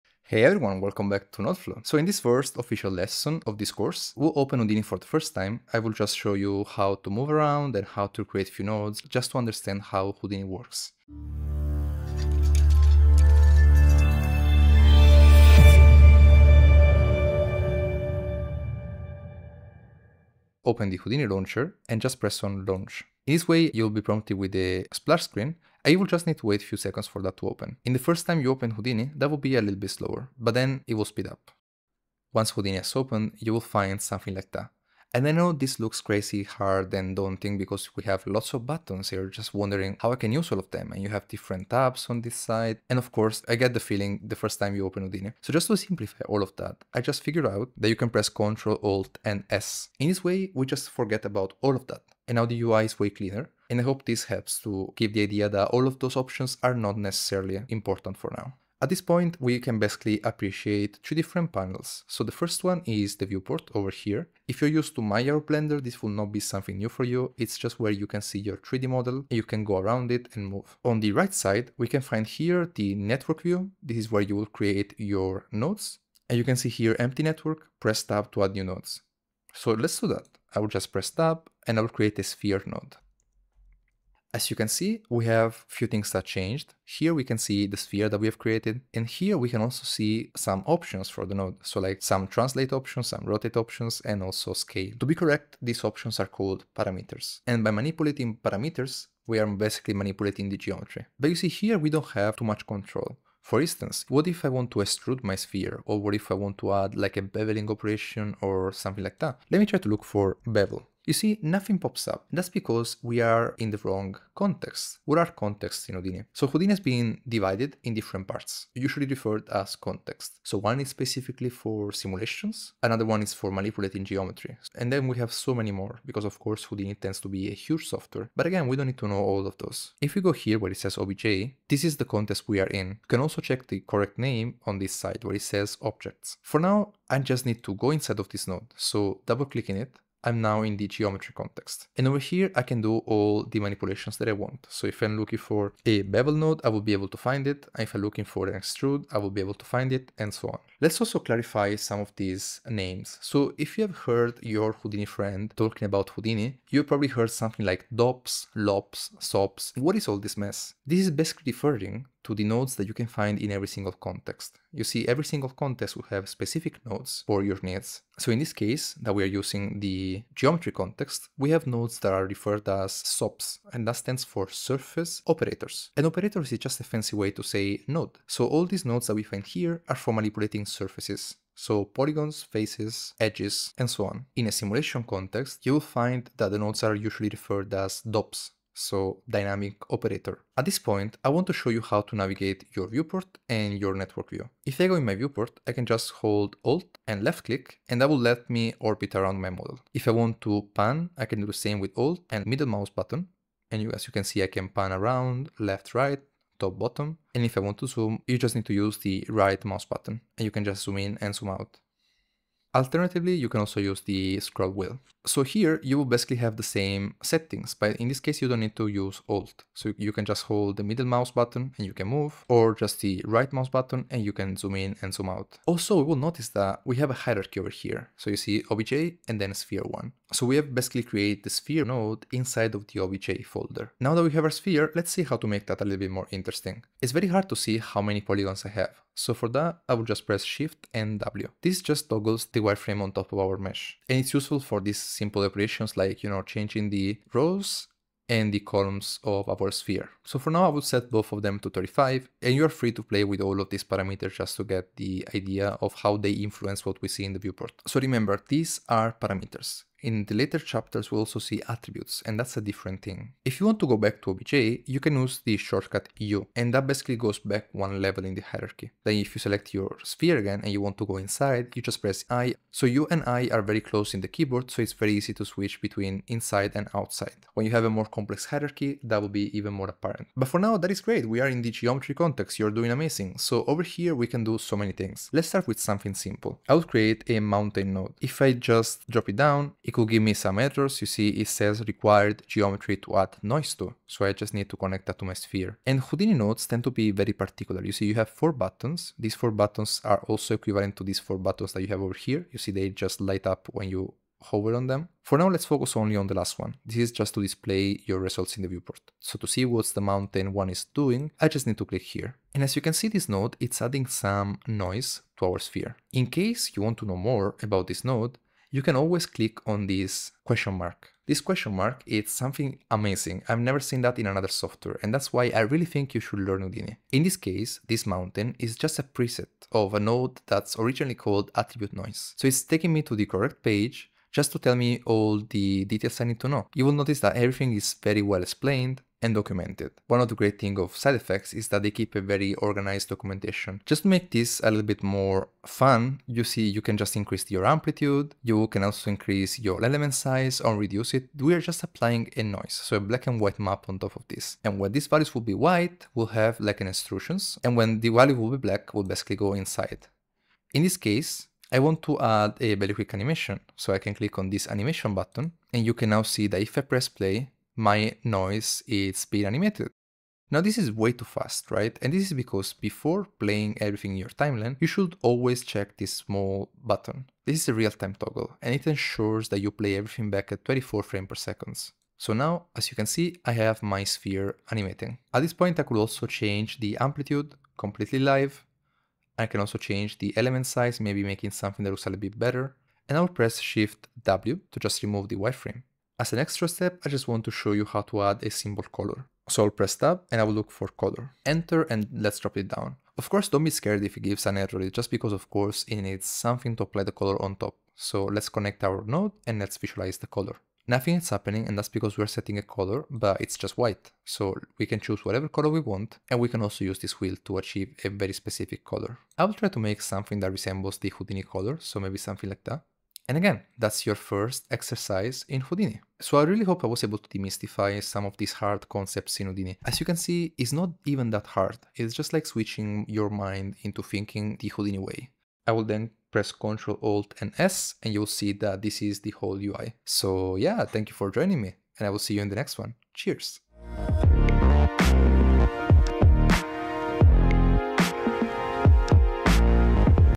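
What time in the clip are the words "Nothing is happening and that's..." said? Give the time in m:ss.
6:50.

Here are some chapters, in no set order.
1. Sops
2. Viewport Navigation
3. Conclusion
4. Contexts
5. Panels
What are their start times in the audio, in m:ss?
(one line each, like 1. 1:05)
1. 4:45
2. 3:10
3. 7:02
4. 1:40
5. 0:20.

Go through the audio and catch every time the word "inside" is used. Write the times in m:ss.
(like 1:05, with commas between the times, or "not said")
2:17, 3:52, 4:31, 4:36, 5:59.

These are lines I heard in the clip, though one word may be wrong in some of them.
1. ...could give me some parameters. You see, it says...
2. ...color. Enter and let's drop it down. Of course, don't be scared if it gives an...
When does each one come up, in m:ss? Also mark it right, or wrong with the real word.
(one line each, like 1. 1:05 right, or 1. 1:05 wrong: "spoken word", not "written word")
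1. 4:49 wrong: "errors", not "parameters"
2. 6:40 right.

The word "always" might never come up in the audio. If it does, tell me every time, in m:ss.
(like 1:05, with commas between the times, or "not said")
5:18, 6:15.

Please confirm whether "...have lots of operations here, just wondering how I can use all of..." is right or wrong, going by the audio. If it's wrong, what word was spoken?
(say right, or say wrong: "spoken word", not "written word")
wrong: "buttons", not "operations".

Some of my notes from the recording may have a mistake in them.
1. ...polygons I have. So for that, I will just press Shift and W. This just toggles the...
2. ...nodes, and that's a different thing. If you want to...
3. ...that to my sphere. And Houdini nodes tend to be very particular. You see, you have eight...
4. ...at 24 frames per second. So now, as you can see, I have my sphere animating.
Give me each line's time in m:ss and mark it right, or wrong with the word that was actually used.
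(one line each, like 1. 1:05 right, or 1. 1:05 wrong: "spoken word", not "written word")
1. 3:58 right
2. 4:21 wrong: "attributes", not "nodes"
3. 4:55 wrong: "four", not "eight"
4. 6:20 right.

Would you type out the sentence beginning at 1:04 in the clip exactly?
If you're used to Maya or Blender, this will not be something new for you.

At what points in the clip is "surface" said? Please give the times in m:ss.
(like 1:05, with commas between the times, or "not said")
2:54, 3:00.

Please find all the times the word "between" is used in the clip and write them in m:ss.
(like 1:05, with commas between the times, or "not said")
4:35.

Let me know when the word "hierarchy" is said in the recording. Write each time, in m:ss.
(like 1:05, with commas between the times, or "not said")
3:47, 4:28, 4:38.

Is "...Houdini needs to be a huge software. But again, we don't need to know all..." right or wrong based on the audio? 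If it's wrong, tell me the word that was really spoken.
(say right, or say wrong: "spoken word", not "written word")
wrong: "tends", not "needs".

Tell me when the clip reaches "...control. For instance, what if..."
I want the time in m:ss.
1:42.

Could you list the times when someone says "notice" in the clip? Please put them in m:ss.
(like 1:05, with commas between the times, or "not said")
3:46, 5:36.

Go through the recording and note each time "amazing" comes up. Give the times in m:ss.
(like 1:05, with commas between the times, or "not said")
4:42, 5:22.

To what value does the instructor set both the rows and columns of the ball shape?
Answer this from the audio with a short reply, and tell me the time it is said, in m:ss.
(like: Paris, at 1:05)
35, at 4:11.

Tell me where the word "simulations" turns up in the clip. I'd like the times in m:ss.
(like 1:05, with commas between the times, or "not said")
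2:01, 3:04.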